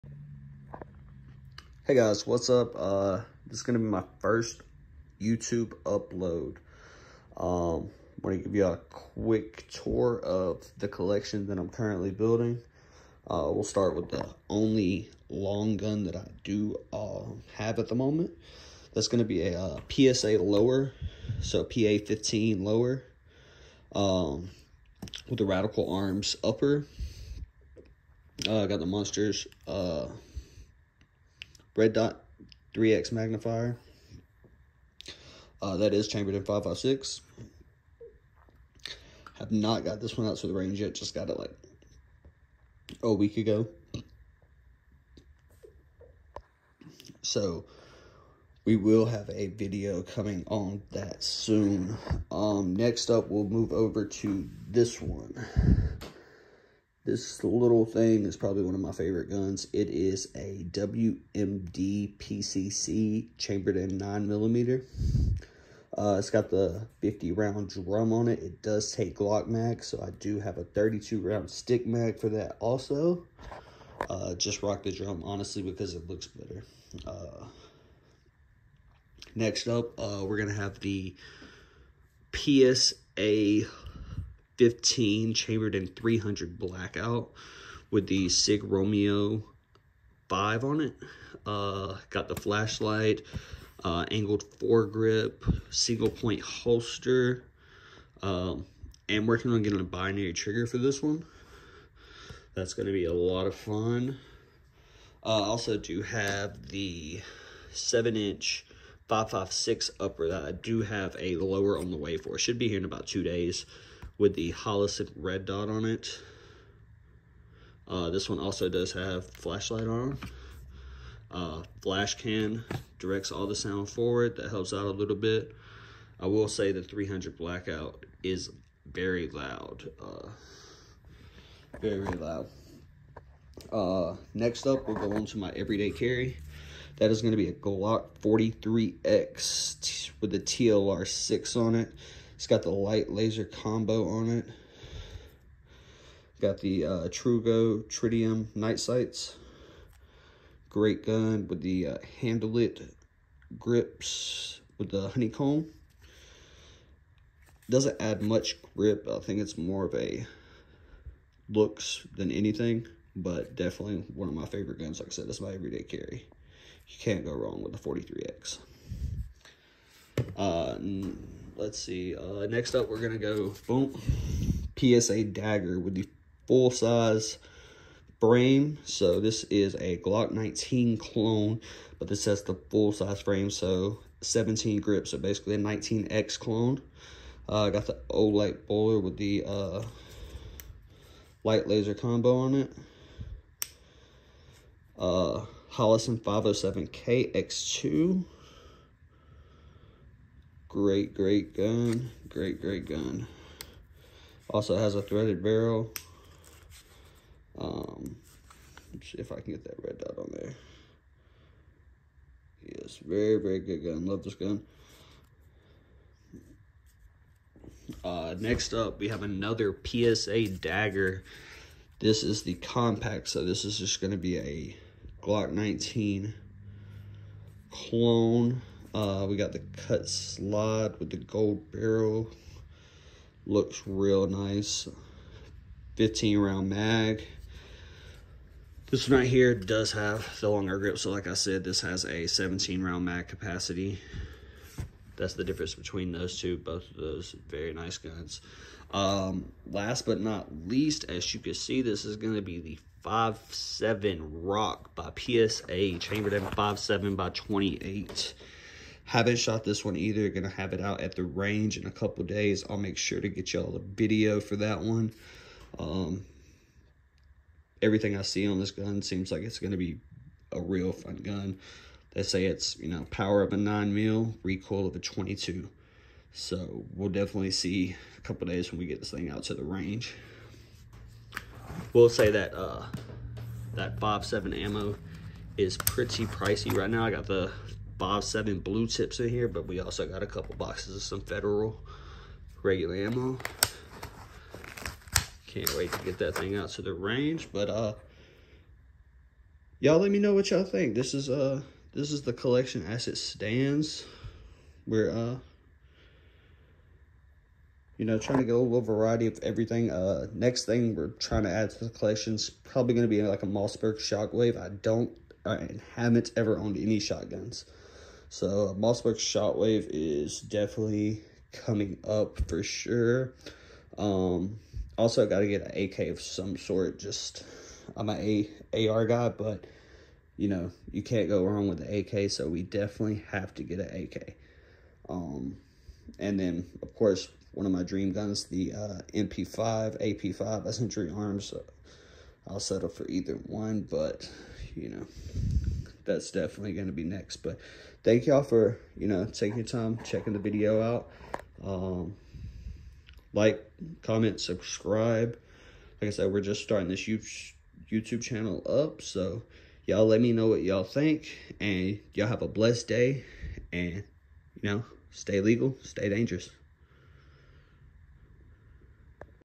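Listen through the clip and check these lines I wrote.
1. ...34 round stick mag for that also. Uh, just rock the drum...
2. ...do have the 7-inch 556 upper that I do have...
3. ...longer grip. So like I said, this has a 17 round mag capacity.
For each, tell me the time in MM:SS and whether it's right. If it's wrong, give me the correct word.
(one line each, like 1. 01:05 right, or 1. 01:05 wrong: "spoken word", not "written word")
1. 01:10 wrong: "32", not "34"
2. 01:45 right
3. 04:00 right.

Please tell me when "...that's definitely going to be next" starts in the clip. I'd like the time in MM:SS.
05:46.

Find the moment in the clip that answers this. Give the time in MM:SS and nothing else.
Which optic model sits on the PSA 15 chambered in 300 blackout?
01:28.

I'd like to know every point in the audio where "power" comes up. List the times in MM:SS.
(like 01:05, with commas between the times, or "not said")
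04:33.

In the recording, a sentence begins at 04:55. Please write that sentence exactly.
Can't wait to get that thing out to the range, but uh, y'all let me know what y'all think.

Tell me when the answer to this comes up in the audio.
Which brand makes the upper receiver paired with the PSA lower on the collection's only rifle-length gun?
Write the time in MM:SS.
00:25.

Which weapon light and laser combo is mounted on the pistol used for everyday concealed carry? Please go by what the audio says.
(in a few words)
TLR6.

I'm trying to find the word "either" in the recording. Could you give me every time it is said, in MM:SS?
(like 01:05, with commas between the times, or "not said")
04:19, 05:43.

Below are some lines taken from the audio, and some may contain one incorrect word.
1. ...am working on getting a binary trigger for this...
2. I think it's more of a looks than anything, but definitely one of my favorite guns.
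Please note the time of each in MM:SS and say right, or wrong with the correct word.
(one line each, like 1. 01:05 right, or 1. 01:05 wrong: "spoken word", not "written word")
1. 01:39 right
2. 02:39 right.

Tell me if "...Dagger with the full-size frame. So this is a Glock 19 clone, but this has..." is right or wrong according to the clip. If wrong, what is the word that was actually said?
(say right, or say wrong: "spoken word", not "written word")
right.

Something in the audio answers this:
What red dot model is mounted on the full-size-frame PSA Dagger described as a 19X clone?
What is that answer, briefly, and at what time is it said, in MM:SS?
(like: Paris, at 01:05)
Holosun 507K X2, at 03:15.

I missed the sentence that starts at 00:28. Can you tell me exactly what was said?
Uh, I got the Monsters uh, red dot 3x magnifier.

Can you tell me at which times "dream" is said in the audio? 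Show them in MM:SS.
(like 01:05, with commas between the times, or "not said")
05:37.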